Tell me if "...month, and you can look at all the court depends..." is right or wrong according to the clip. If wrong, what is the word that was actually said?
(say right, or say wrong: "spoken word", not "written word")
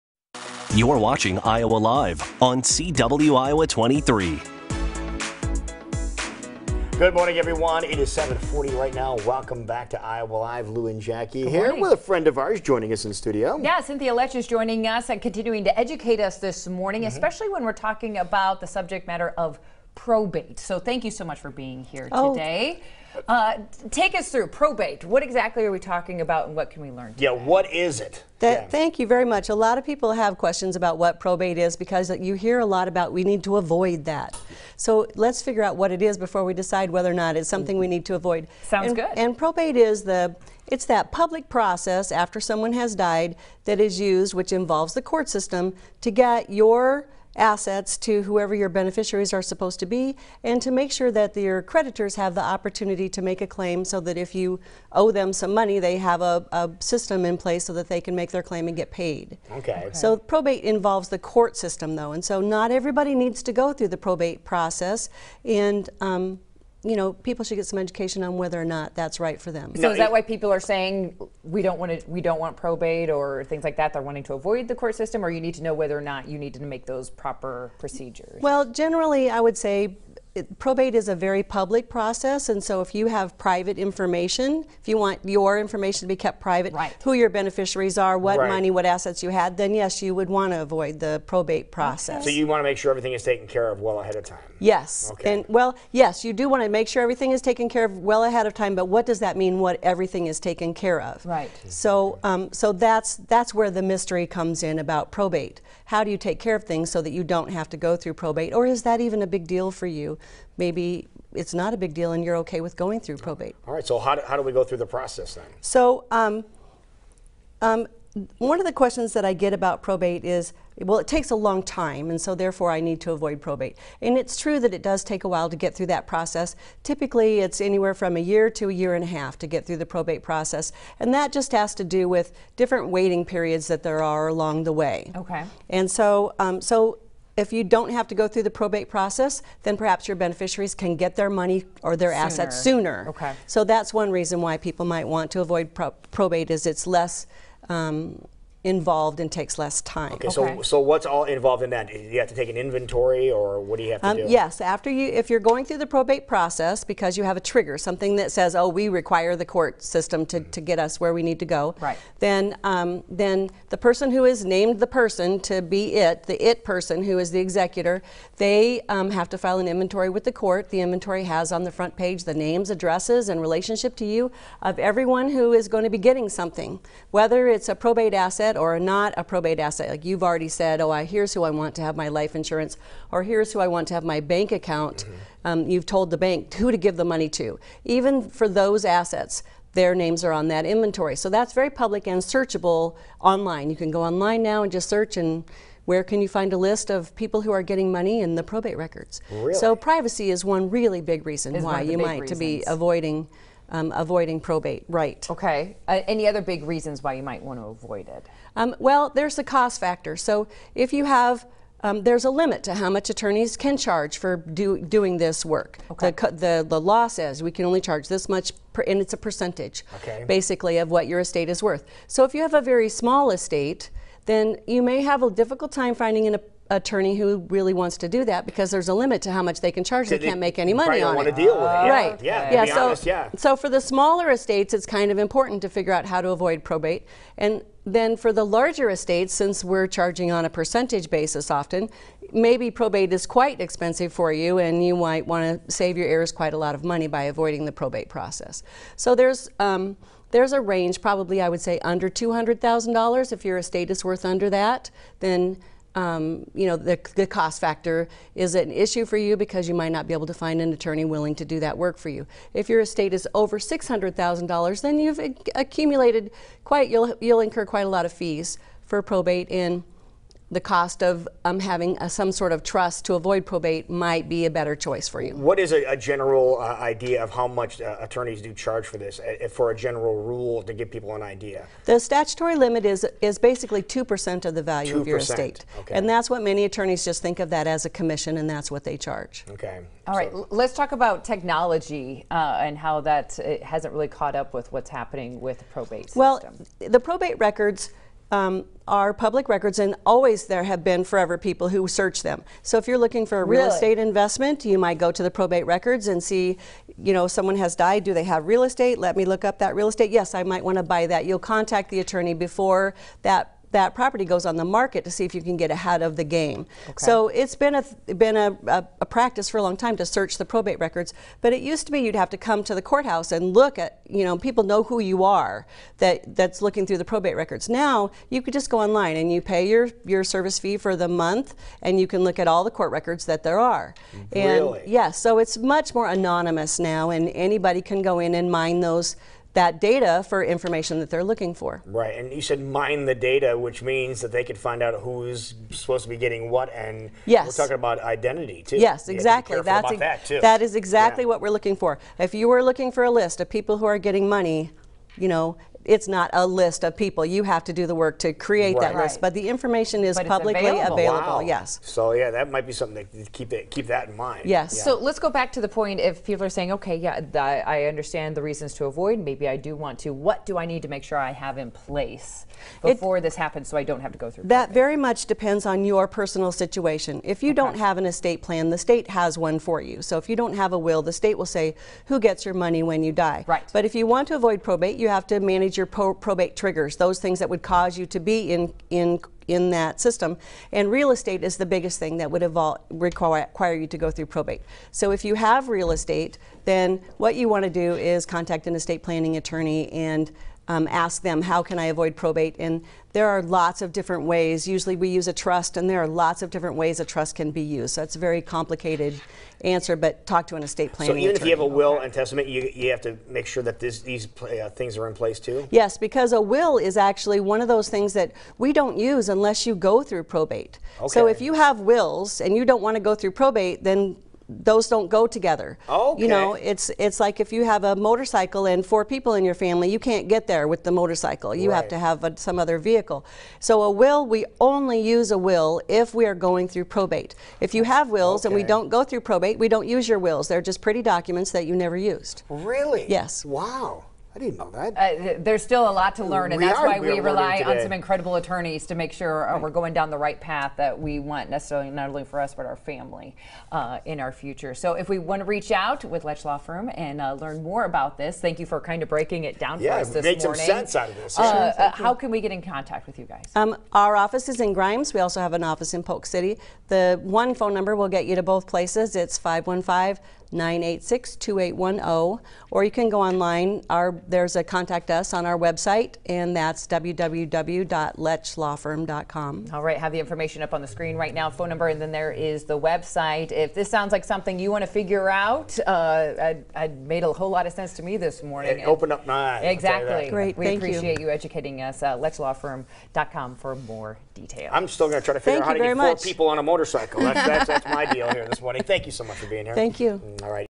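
wrong: "records", not "depends".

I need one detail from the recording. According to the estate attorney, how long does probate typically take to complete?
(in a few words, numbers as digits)
a year to a year and a half.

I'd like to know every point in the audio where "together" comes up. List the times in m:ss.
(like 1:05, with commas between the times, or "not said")
7:05.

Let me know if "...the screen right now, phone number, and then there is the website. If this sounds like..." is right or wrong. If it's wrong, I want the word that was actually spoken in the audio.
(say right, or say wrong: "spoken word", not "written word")
right.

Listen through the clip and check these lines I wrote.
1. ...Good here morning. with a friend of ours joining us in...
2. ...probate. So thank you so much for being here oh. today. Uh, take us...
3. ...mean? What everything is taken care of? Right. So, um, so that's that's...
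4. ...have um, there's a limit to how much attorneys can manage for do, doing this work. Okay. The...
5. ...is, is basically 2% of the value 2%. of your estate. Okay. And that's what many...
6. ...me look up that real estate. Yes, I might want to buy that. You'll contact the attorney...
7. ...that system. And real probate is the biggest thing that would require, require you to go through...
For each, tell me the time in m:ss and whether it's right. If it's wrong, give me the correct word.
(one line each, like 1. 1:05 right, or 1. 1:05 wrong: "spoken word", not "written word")
1. 0:11 right
2. 0:19 right
3. 1:39 right
4. 3:31 wrong: "charge", not "manage"
5. 4:42 right
6. 5:09 right
7. 6:29 wrong: "estate", not "probate".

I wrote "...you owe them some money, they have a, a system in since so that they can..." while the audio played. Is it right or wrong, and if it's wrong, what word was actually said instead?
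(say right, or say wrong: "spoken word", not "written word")
wrong: "place", not "since".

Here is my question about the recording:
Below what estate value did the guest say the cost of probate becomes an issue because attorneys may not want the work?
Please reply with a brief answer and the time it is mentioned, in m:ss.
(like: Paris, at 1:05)
$200,000, at 4:12.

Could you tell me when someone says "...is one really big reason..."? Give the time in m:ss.
3:20.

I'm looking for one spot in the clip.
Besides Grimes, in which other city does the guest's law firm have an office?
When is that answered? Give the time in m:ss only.
7:46.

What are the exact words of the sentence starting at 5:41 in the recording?
Right, and you said mine the data, which means that they could find out who's supposed to be getting what, and yes.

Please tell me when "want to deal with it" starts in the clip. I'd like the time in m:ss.
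3:51.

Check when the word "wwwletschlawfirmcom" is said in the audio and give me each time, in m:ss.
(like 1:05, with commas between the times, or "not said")
7:56.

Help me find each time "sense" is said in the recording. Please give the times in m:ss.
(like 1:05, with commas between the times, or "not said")
7:40, 8:07.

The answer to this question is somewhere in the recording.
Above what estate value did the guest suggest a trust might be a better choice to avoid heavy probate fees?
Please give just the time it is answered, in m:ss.
4:23.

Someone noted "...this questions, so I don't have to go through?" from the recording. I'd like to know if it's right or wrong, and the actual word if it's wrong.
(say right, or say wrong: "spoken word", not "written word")
wrong: "happens", not "questions".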